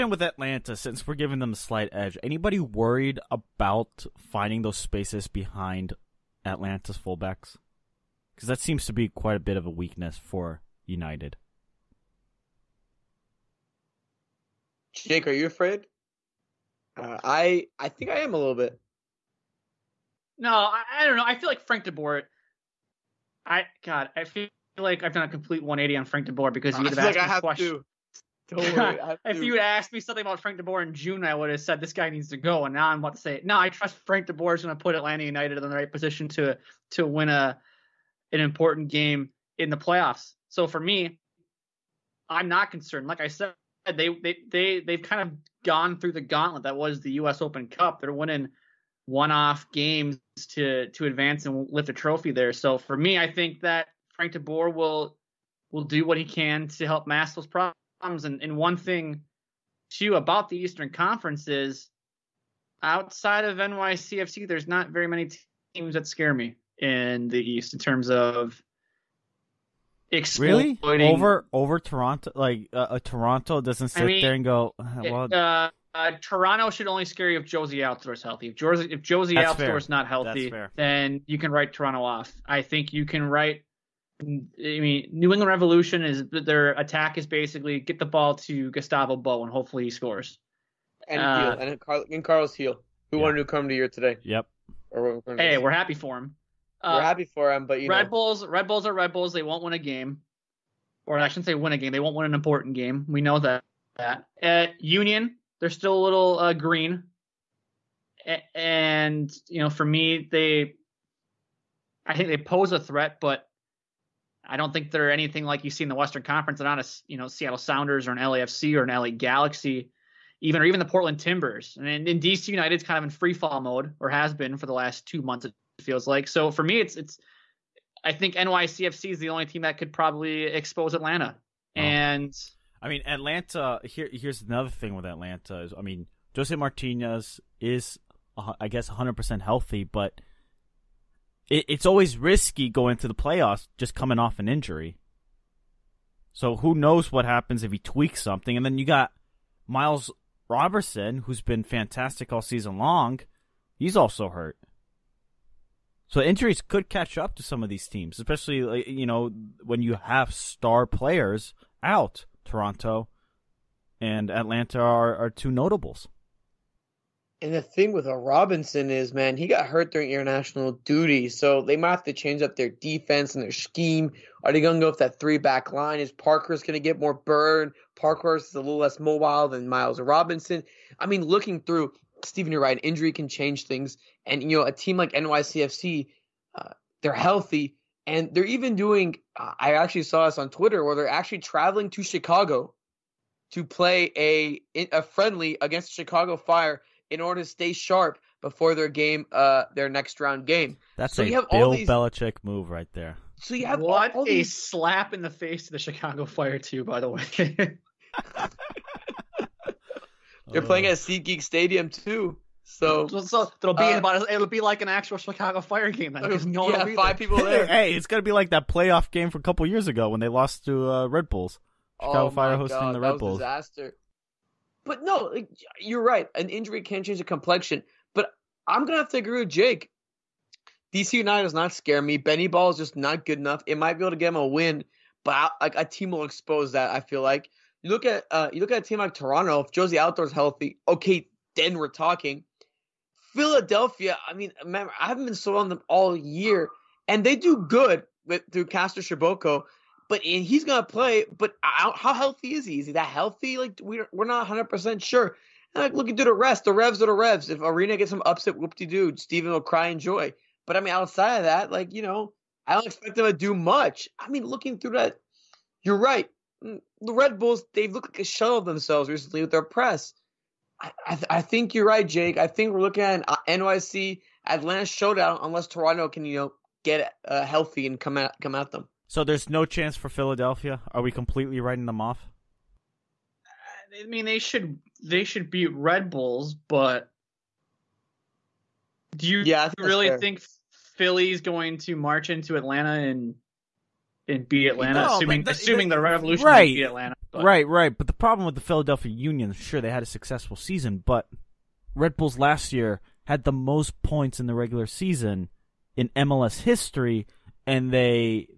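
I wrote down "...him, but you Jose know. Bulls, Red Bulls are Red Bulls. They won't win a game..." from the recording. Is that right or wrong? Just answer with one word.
wrong.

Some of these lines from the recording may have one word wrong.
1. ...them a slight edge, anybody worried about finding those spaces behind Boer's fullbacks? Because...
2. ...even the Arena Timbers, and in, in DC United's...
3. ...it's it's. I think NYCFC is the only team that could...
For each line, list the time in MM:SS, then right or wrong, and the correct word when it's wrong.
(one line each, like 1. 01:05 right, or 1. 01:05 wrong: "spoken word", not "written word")
1. 00:01 wrong: "Atlanta", not "Boer"
2. 02:00 wrong: "Portland", not "Arena"
3. 02:06 right.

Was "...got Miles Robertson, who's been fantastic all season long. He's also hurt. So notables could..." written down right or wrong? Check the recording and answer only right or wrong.
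wrong.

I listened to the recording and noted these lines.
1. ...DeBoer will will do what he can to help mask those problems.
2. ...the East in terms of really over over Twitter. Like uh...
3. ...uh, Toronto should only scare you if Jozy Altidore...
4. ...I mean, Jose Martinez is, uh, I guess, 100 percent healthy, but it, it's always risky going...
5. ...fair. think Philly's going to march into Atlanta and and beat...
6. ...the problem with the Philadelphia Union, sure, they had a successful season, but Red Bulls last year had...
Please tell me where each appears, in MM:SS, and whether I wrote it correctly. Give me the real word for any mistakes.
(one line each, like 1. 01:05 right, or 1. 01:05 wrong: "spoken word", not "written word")
1. 00:54 right
2. 01:07 wrong: "Toronto", not "Twitter"
3. 01:15 right
4. 02:15 right
5. 04:50 right
6. 04:58 right.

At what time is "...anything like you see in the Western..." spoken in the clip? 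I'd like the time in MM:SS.
01:55.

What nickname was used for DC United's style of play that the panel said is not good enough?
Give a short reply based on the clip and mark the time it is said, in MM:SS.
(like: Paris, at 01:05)
Benny Ball, at 03:52.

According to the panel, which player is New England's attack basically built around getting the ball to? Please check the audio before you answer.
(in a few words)
Gustavo Bou.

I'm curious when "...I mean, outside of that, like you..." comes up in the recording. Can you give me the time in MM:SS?
04:20.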